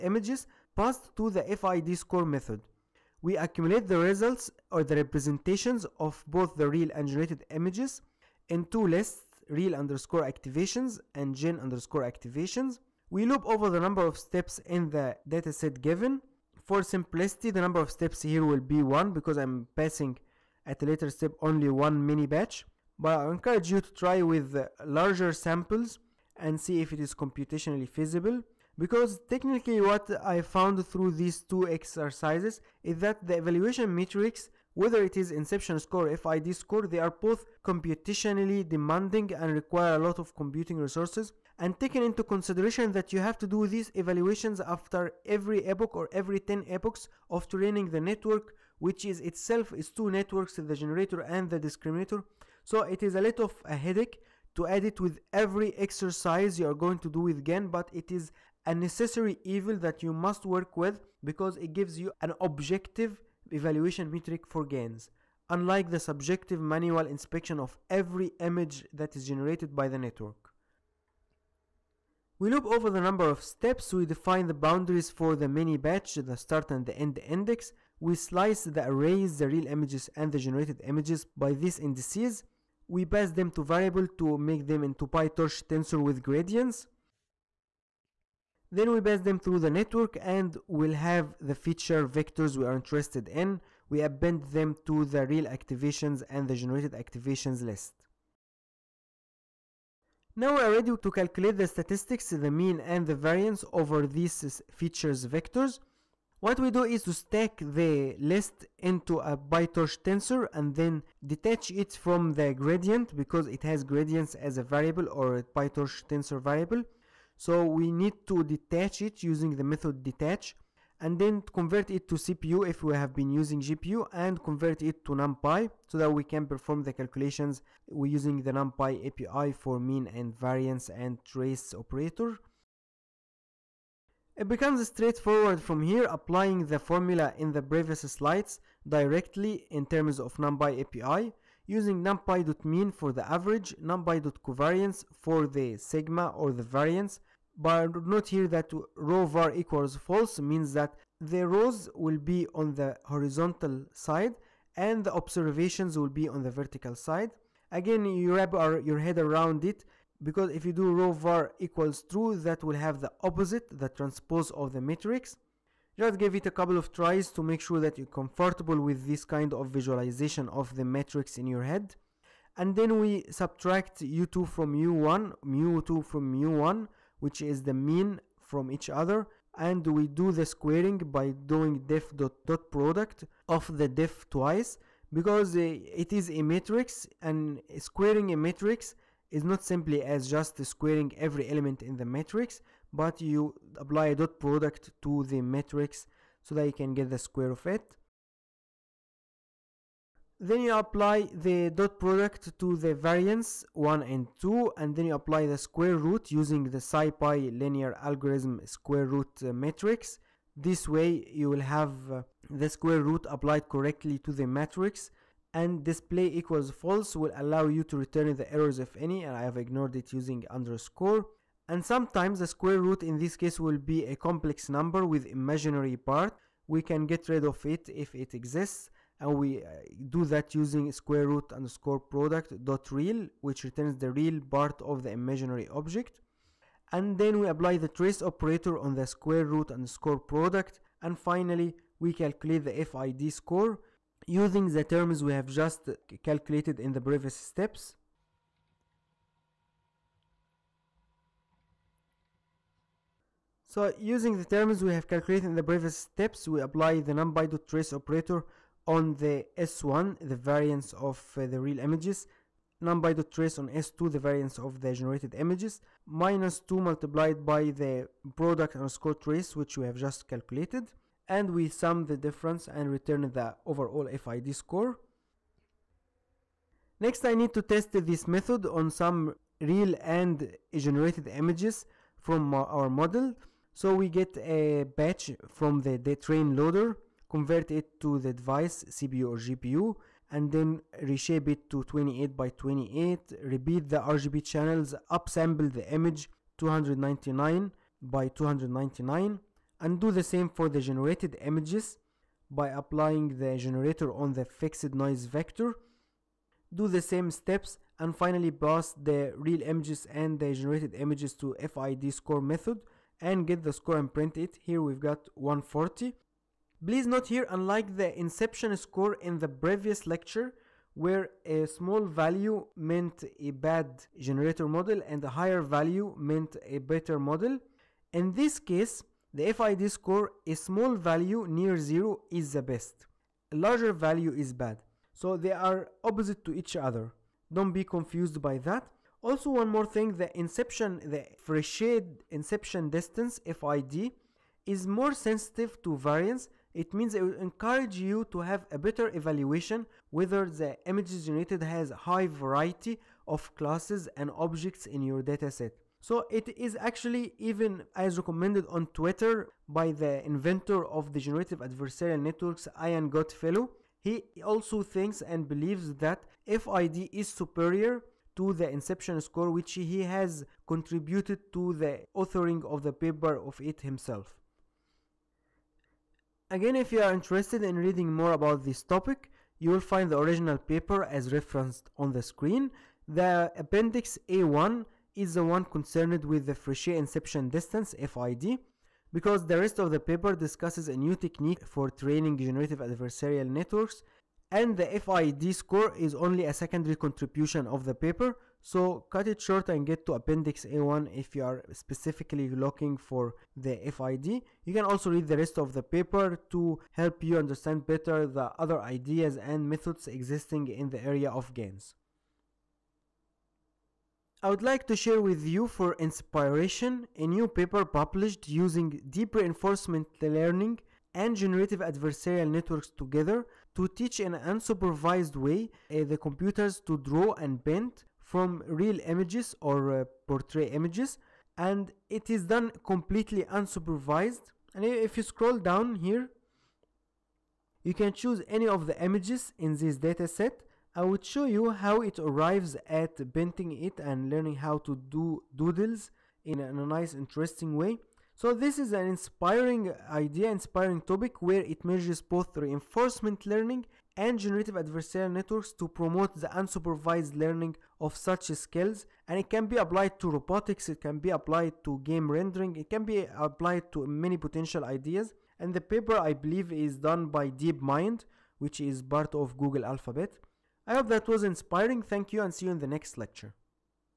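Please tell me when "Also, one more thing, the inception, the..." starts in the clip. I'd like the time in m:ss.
5:39.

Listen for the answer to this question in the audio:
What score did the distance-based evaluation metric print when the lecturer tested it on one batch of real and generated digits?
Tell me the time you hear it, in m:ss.
5:15.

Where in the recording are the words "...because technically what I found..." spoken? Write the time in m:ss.
0:28.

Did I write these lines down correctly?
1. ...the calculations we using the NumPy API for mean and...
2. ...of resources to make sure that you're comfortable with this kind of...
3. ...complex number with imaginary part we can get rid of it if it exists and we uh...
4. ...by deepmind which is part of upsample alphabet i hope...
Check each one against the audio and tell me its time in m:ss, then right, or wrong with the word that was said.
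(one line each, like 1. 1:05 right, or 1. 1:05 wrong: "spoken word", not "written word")
1. 2:06 right
2. 2:46 wrong: "tries", not "resources"
3. 3:44 right
4. 7:47 wrong: "google", not "upsample".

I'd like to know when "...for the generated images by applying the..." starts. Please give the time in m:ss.
5:00.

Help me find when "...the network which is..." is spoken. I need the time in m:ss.
0:47.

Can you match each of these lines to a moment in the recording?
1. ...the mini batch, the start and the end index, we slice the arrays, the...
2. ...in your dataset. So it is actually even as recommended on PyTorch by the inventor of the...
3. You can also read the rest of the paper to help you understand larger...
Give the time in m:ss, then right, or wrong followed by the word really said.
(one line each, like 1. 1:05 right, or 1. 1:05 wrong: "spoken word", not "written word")
1. 1:15 right
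2. 5:54 wrong: "Twitter", not "PyTorch"
3. 6:44 wrong: "better", not "larger".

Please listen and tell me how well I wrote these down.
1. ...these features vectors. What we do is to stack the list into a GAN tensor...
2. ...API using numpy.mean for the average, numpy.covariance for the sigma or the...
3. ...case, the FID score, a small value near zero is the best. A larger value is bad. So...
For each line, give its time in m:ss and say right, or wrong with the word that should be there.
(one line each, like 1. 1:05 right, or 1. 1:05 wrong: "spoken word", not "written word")
1. 1:44 wrong: "PyTorch", not "GAN"
2. 2:20 right
3. 5:28 right.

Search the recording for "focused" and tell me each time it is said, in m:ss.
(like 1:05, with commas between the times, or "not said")
not said.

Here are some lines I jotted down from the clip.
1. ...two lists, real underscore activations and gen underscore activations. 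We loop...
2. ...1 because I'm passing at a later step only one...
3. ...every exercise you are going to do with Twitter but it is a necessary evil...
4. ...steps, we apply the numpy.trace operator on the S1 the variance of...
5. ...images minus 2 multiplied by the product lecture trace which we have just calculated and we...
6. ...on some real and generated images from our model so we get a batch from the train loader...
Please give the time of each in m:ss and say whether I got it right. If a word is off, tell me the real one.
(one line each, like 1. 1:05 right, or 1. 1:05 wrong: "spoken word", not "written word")
1. 0:08 right
2. 0:18 right
3. 0:55 wrong: "GAN", not "Twitter"
4. 4:15 right
5. 4:25 wrong: "underscore", not "lecture"
6. 4:38 right.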